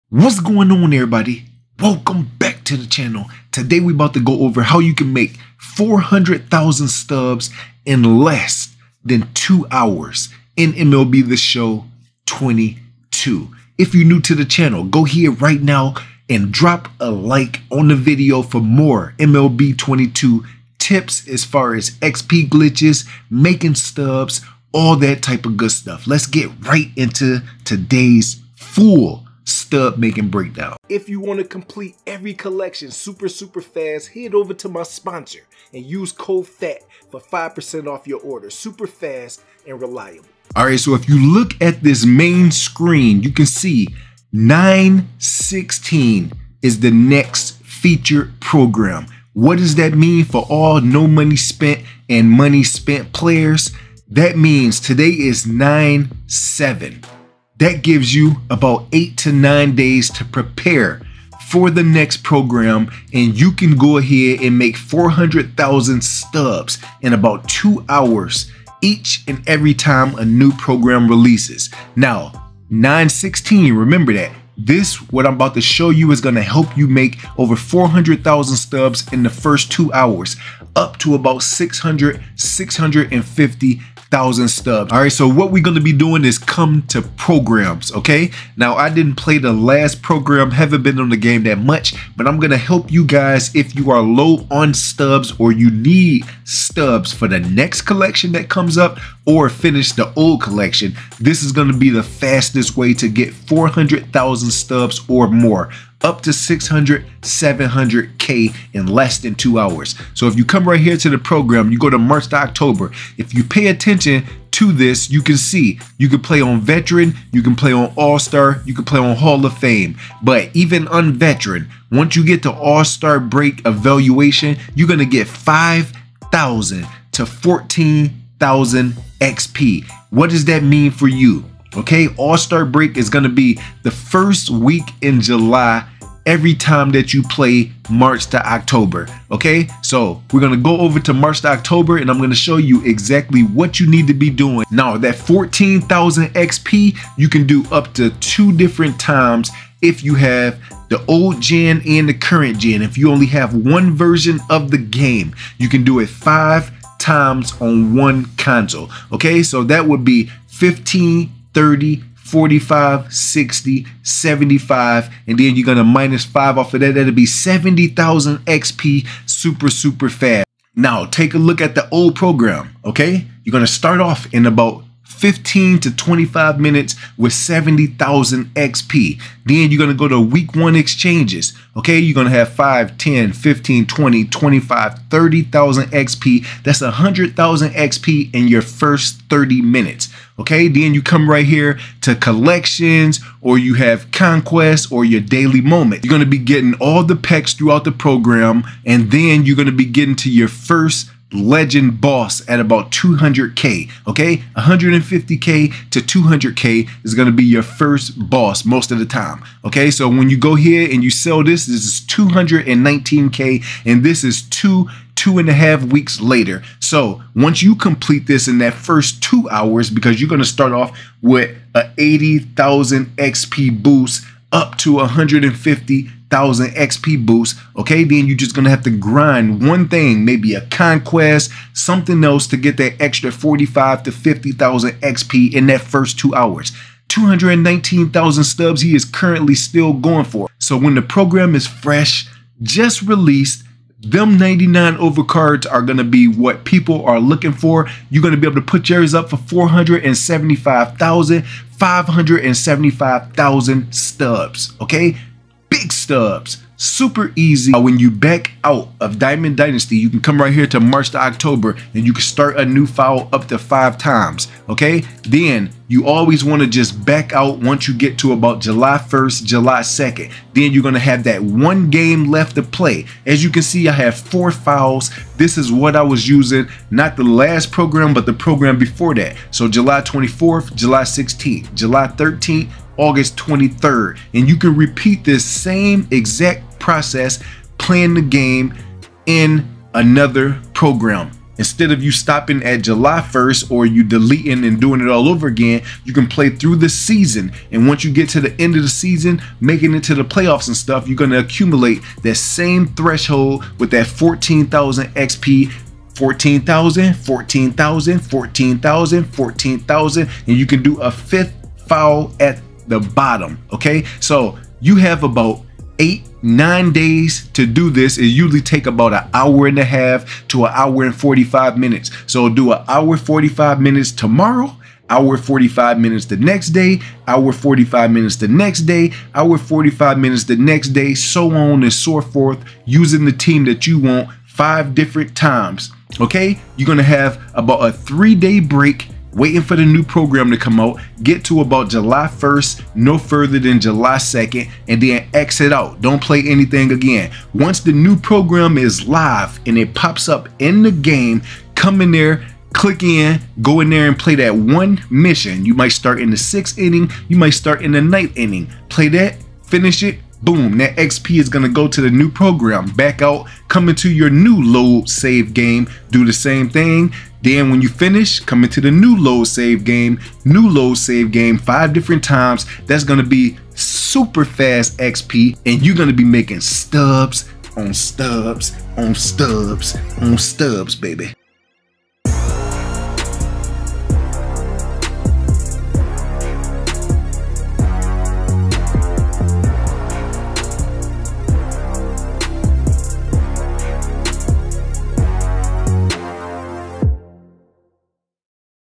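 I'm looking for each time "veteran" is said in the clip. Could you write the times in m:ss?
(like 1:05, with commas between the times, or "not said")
1:56, 2:01.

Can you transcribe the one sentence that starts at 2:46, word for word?
That'll be 70,000 XP super, super fast.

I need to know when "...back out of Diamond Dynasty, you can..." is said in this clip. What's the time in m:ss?
4:18.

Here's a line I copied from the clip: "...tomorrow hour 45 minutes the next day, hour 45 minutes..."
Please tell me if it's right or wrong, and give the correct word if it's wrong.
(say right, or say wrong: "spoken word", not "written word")
right.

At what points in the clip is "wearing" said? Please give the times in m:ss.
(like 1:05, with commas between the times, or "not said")
not said.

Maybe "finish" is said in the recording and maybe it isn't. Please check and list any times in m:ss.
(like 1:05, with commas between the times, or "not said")
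1:39, 5:59, 6:07.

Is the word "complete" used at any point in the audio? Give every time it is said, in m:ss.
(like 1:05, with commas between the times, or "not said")
0:31, 3:37.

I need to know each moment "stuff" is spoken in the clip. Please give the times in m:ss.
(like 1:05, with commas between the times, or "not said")
0:25, 5:00.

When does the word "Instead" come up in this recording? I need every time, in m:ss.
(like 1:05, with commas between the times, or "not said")
4:51.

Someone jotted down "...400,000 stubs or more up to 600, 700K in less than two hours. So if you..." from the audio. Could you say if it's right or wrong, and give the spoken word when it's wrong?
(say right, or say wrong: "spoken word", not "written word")
right.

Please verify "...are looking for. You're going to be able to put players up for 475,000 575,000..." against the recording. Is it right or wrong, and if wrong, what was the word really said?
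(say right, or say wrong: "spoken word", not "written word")
wrong: "yours", not "players".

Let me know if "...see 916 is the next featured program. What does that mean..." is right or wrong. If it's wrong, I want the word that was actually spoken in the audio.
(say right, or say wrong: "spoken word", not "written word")
right.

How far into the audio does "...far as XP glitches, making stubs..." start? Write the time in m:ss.
0:21.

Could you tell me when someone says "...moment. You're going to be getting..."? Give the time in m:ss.
3:15.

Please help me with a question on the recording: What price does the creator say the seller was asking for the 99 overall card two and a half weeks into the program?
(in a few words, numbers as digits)
219,000 stubs.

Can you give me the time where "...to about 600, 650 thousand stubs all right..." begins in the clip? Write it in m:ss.
1:20.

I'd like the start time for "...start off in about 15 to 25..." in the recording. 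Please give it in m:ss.
2:53.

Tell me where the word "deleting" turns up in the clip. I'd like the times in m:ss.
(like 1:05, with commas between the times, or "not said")
4:54.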